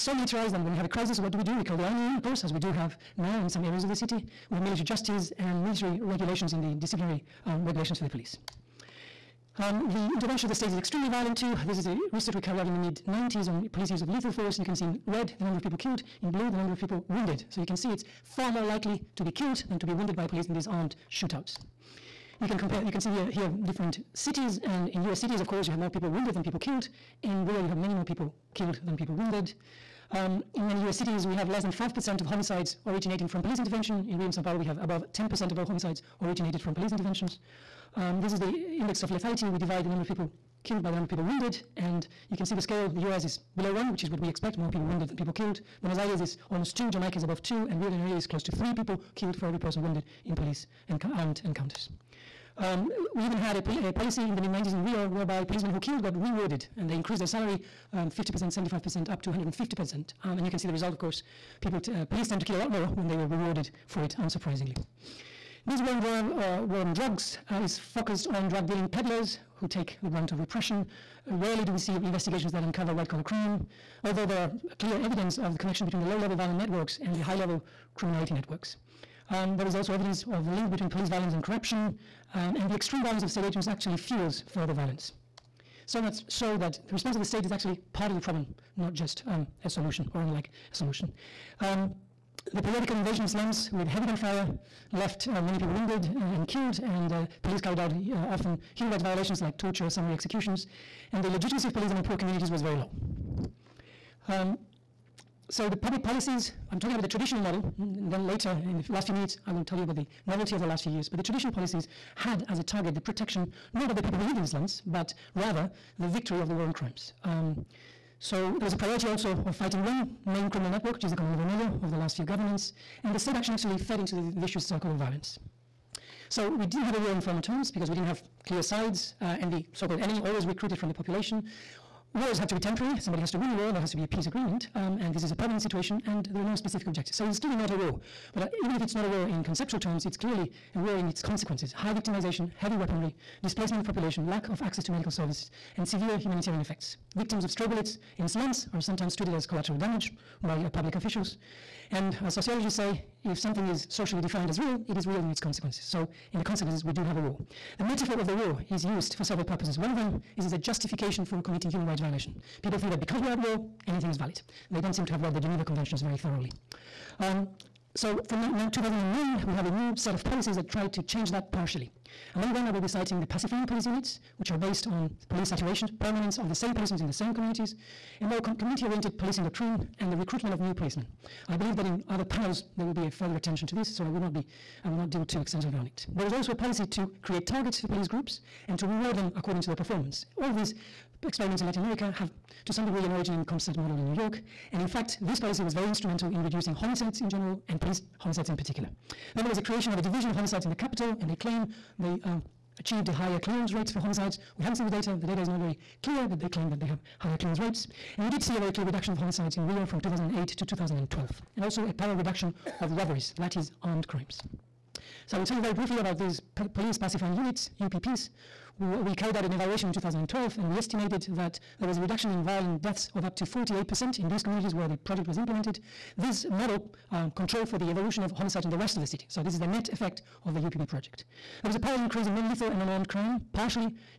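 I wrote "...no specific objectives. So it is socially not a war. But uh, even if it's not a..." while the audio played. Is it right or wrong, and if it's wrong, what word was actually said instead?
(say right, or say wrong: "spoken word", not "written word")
wrong: "clearly", not "socially".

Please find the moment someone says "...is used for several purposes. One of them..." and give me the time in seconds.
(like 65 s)
158 s.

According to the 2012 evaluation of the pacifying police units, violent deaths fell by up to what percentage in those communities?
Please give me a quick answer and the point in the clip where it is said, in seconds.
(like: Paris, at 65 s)
48%, at 223 s.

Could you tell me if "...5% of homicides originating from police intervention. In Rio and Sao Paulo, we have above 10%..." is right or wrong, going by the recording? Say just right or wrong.
right.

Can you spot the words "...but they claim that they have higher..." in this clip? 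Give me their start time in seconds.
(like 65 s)
206 s.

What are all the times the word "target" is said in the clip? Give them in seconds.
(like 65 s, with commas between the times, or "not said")
112 s, 187 s.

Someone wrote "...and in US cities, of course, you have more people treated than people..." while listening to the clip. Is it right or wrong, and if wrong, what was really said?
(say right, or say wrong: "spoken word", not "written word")
wrong: "wounded", not "treated".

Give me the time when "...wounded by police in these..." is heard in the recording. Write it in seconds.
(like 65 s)
19 s.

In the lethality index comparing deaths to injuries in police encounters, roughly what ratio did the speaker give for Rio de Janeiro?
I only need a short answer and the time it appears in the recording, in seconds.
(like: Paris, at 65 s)
close to 3, at 48 s.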